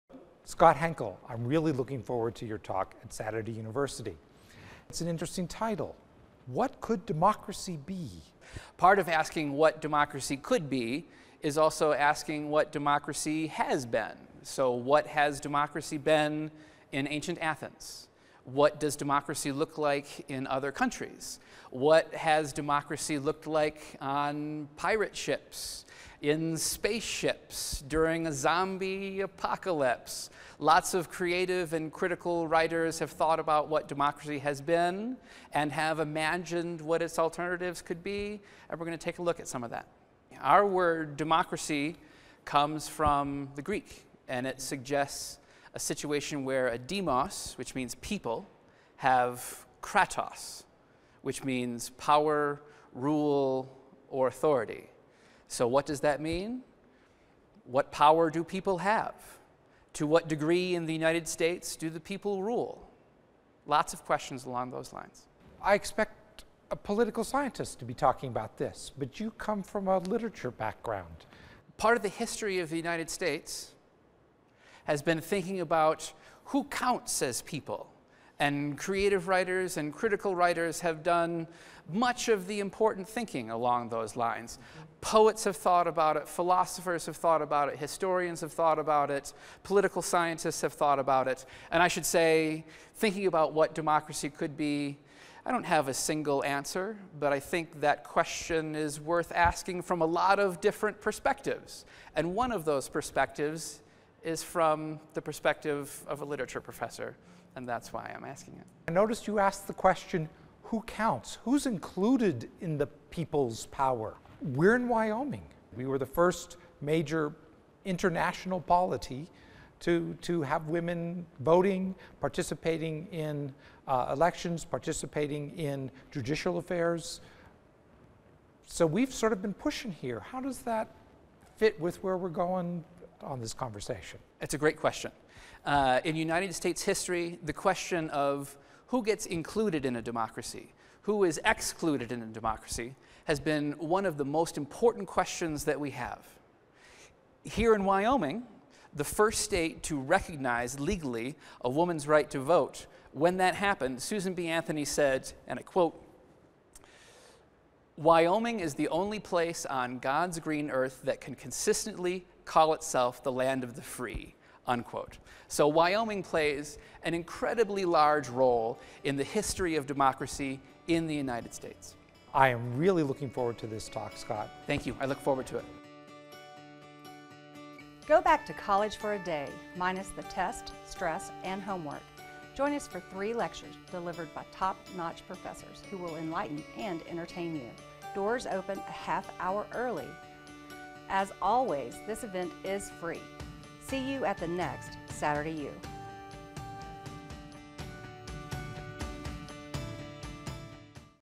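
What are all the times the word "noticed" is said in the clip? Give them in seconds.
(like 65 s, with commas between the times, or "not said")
108 s.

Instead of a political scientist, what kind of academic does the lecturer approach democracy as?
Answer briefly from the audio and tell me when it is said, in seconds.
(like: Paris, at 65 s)
literature professor, at 106 s.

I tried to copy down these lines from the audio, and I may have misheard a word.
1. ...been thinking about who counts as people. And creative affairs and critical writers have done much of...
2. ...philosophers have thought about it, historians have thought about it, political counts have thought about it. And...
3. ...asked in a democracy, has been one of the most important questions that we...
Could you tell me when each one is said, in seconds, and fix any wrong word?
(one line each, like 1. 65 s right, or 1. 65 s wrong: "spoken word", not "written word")
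1. 75 s wrong: "writers", not "affairs"
2. 86 s wrong: "scientists", not "counts"
3. 141 s wrong: "excluded", not "asked".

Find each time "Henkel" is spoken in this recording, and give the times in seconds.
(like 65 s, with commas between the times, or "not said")
0 s.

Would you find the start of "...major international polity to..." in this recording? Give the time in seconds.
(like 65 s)
116 s.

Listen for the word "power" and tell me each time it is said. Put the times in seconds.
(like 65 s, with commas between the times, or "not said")
51 s, 57 s, 113 s.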